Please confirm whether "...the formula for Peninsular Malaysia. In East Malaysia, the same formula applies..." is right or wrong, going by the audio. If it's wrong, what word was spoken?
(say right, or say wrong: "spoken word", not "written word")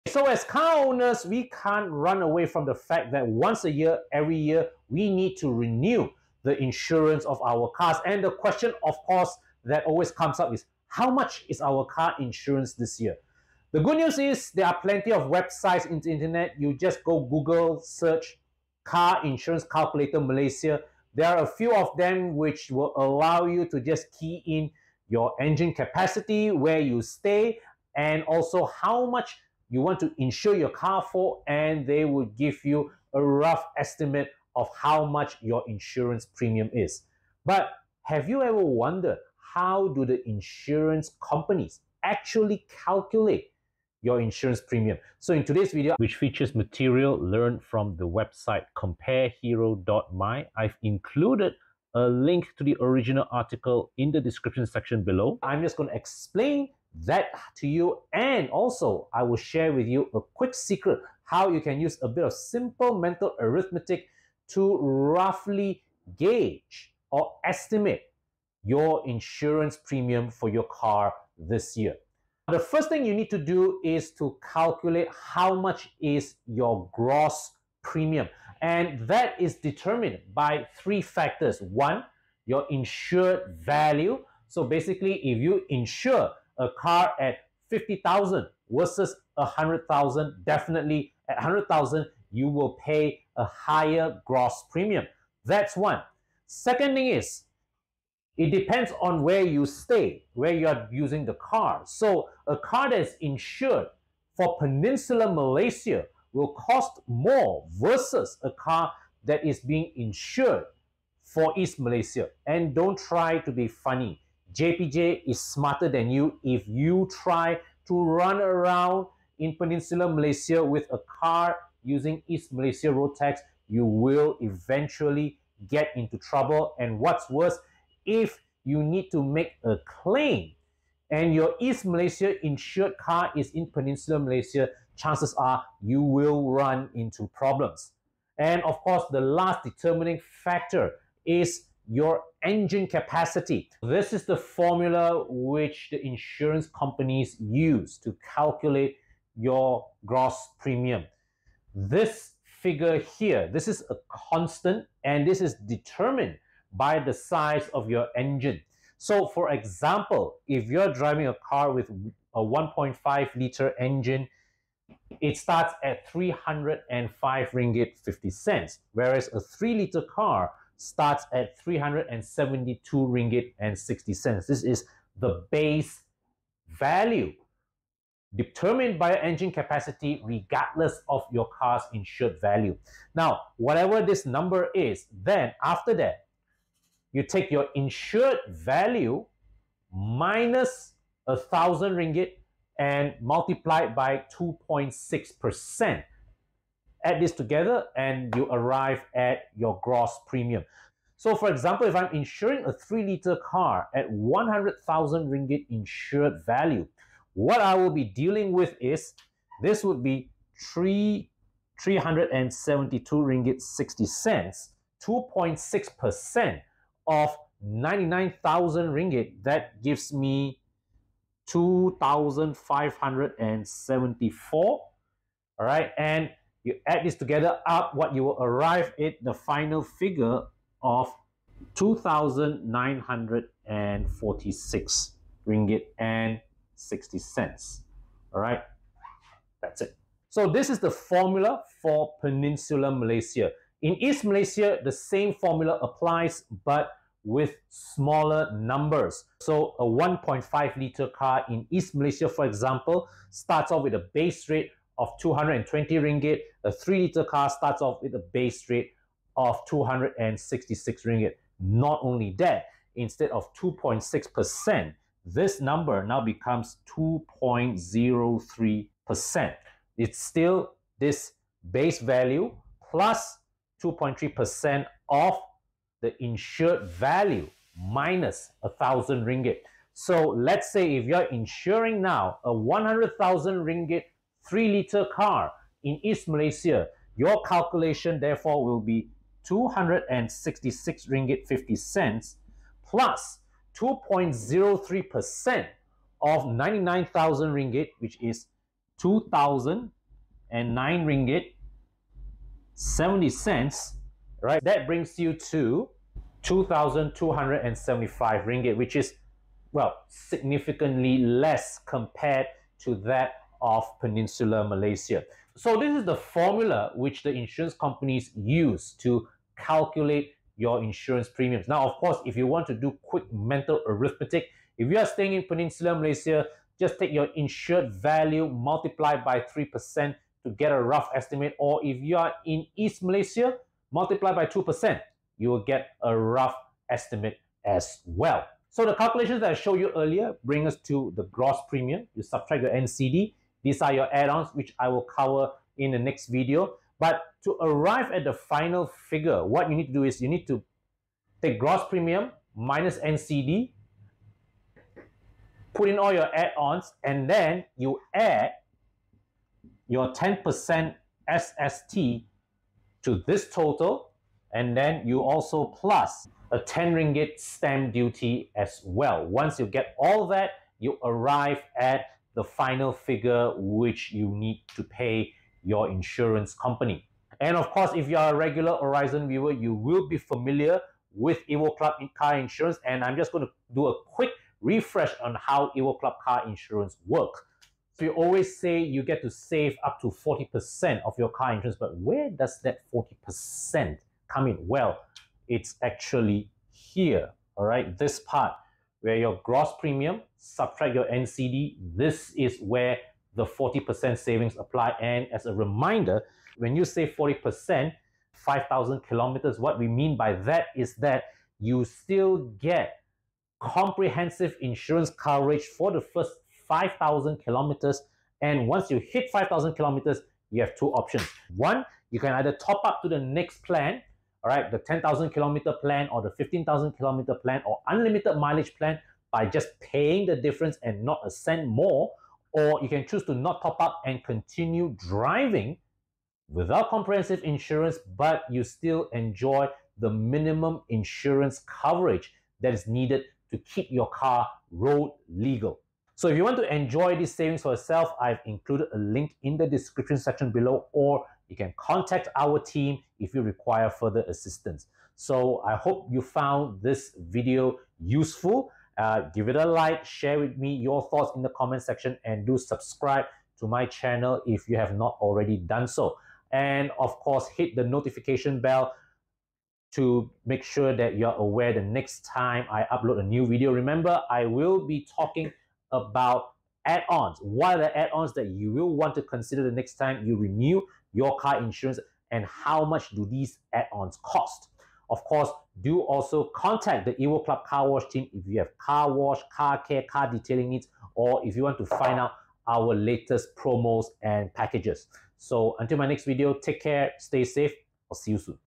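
right.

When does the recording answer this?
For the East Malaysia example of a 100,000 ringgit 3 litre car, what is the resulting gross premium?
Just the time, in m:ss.
5:06.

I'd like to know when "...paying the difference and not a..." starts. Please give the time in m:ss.
7:09.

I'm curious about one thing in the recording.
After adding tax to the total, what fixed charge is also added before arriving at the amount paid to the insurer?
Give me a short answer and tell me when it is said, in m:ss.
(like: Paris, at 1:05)
10 ringgit stamp duty, at 6:06.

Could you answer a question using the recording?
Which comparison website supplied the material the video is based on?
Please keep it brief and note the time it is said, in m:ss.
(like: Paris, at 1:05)
comparehero.my, at 0:48.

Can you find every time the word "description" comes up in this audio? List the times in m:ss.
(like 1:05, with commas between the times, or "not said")
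0:54, 7:29.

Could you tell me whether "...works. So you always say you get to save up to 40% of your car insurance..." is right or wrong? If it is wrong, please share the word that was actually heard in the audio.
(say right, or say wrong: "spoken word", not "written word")
right.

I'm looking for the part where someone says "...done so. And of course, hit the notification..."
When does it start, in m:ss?
7:45.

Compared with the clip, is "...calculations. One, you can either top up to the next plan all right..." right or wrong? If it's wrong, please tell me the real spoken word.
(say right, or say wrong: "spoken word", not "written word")
wrong: "options", not "calculations".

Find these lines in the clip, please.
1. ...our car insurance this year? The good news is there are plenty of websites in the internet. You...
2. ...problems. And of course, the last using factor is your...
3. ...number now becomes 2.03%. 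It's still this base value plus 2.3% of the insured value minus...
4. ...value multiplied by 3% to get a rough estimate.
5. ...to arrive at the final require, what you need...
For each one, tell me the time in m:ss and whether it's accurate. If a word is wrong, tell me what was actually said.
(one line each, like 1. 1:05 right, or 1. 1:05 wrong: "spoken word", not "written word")
1. 0:11 right
2. 2:17 wrong: "determining", not "using"
3. 4:25 right
4. 5:27 right
5. 5:47 wrong: "figure", not "require".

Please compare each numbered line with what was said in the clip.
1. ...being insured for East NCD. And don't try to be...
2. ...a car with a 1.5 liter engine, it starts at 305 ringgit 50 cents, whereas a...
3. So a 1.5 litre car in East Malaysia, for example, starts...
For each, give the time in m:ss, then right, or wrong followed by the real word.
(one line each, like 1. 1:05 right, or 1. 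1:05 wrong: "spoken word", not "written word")
1. 1:49 wrong: "Malaysia", not "NCD"
2. 2:41 right
3. 4:09 right.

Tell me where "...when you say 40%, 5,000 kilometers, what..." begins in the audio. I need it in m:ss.
6:46.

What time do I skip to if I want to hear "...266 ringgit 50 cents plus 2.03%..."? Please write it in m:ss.
4:49.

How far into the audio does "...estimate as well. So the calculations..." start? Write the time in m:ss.
5:36.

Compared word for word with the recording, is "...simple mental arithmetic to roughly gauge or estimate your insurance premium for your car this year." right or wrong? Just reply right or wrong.
right.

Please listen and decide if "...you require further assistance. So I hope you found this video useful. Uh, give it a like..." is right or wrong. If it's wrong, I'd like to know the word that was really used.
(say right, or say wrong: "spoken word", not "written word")
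right.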